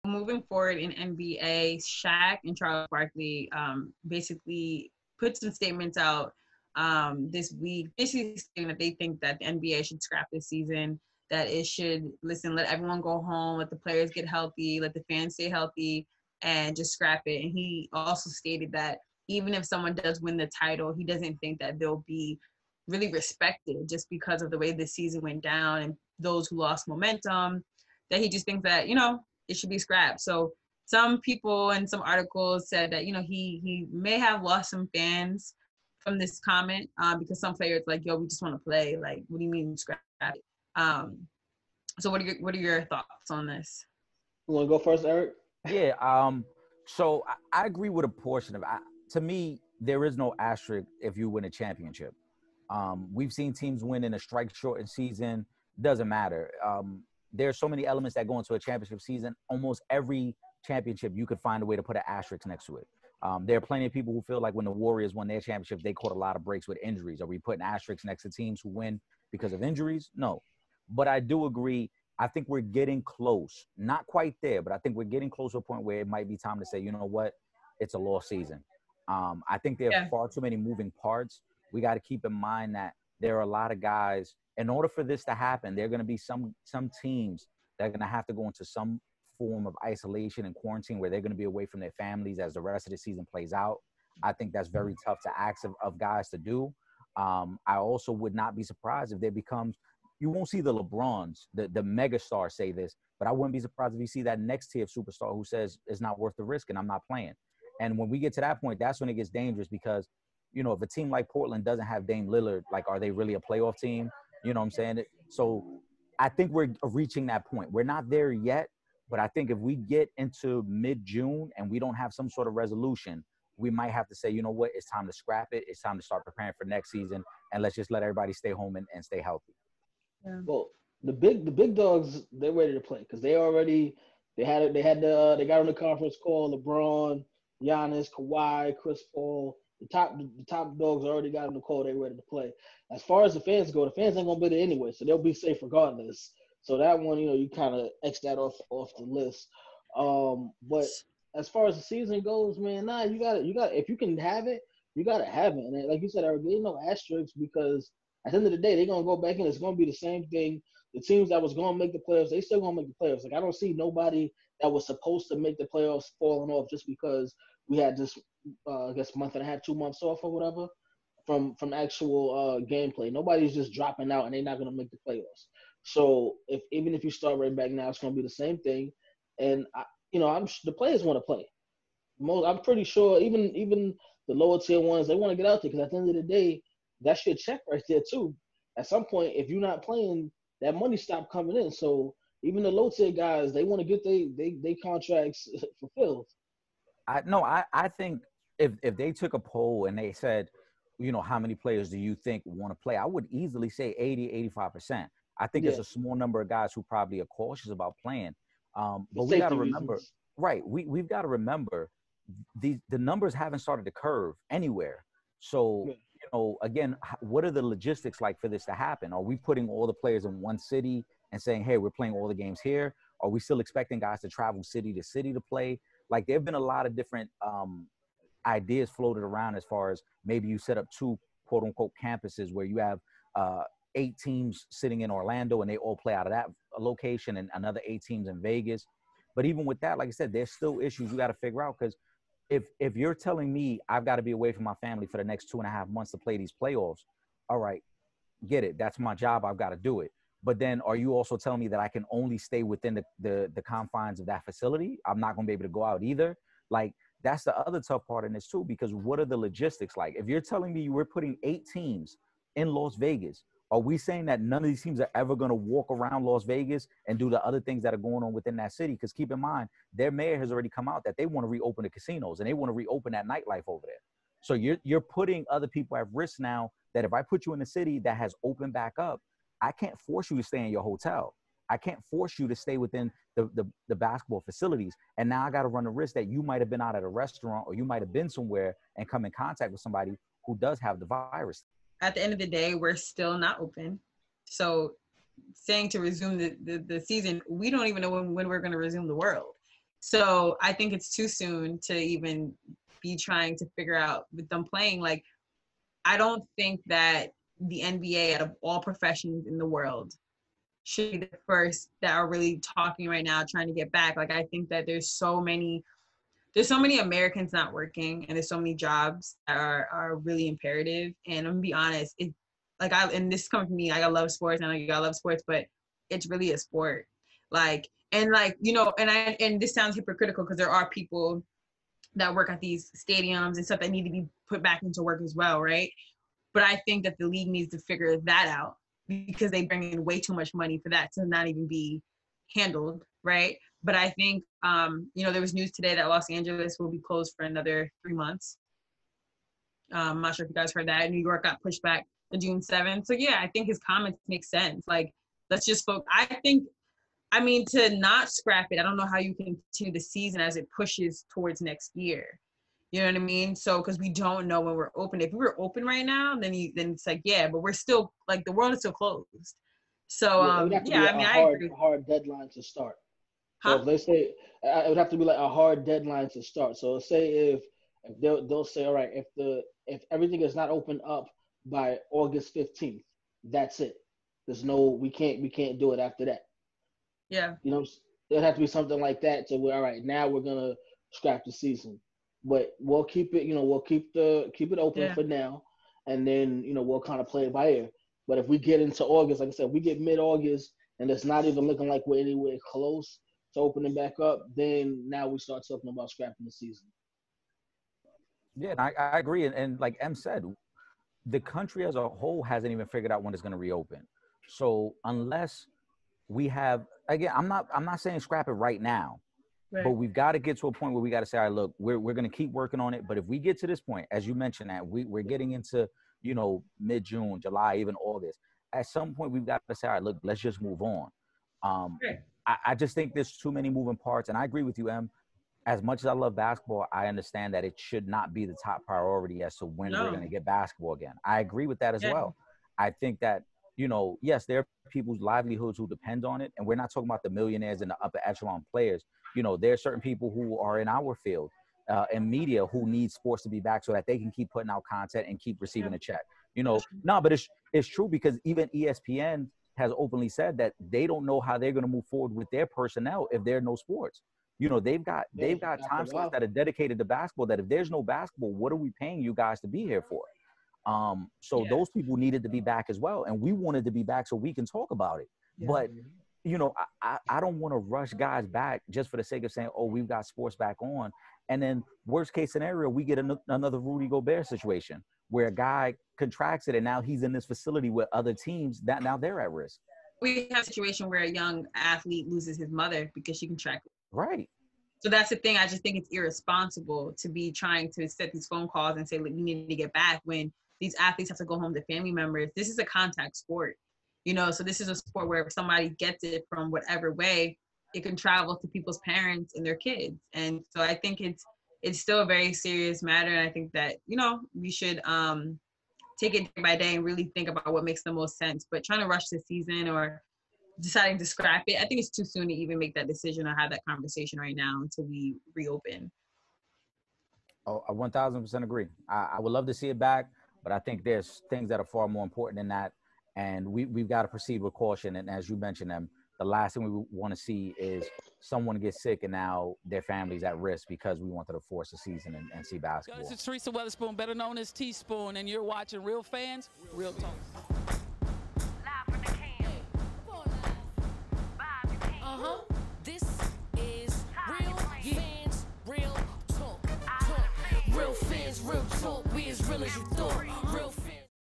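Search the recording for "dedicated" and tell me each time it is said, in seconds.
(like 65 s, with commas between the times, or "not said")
466 s.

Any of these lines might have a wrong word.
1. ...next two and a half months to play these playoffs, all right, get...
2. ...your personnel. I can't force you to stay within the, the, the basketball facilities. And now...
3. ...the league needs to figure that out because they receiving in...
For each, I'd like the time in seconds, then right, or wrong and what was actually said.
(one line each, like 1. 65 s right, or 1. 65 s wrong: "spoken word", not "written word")
1. 245 s right
2. 280 s wrong: "hotel", not "personnel"
3. 337 s wrong: "bring", not "receiving".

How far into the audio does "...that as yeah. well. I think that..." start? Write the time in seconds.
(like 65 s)
441 s.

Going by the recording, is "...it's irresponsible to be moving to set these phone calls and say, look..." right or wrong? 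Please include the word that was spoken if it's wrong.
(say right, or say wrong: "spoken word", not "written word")
wrong: "trying", not "moving".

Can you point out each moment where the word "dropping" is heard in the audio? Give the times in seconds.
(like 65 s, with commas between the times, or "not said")
173 s.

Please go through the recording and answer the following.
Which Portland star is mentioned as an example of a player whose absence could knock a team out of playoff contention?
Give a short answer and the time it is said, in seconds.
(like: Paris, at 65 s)
Dame Lillard, at 112 s.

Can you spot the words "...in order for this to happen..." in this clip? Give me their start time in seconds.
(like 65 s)
84 s.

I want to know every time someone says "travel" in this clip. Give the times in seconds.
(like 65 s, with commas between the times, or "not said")
224 s, 508 s.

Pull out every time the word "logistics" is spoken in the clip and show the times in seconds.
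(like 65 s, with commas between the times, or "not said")
217 s, 259 s.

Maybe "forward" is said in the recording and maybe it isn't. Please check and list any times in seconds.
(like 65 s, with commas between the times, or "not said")
0 s, 462 s.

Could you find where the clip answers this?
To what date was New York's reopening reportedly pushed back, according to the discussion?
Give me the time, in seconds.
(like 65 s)
352 s.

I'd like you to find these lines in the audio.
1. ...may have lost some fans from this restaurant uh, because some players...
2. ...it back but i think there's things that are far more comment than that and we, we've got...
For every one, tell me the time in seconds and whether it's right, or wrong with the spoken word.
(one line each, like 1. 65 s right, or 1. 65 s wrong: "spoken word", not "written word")
1. 33 s wrong: "comment", not "restaurant"
2. 529 s wrong: "important", not "comment".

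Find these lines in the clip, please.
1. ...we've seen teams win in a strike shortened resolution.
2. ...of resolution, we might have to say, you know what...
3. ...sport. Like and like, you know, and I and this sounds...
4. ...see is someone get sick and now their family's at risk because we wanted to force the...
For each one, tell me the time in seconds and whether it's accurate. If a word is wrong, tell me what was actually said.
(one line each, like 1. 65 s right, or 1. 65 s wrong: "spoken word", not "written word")
1. 53 s wrong: "season", not "resolution"
2. 122 s right
3. 326 s right
4. 537 s right.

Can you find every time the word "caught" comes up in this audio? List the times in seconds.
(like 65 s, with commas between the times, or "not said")
65 s.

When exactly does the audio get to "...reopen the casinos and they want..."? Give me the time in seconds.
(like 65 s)
271 s.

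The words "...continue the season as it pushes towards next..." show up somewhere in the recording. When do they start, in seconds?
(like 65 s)
359 s.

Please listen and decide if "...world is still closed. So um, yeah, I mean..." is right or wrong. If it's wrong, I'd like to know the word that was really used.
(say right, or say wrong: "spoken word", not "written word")
right.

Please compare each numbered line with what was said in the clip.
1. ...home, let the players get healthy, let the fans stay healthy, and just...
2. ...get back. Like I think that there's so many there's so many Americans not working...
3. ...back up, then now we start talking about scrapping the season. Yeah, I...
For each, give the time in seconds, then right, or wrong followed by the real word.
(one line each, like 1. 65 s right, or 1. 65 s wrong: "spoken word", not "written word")
1. 13 s right
2. 313 s right
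3. 403 s right.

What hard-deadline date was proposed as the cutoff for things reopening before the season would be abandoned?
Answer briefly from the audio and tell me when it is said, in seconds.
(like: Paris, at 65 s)
August 15th, at 382 s.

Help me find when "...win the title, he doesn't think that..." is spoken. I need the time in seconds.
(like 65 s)
20 s.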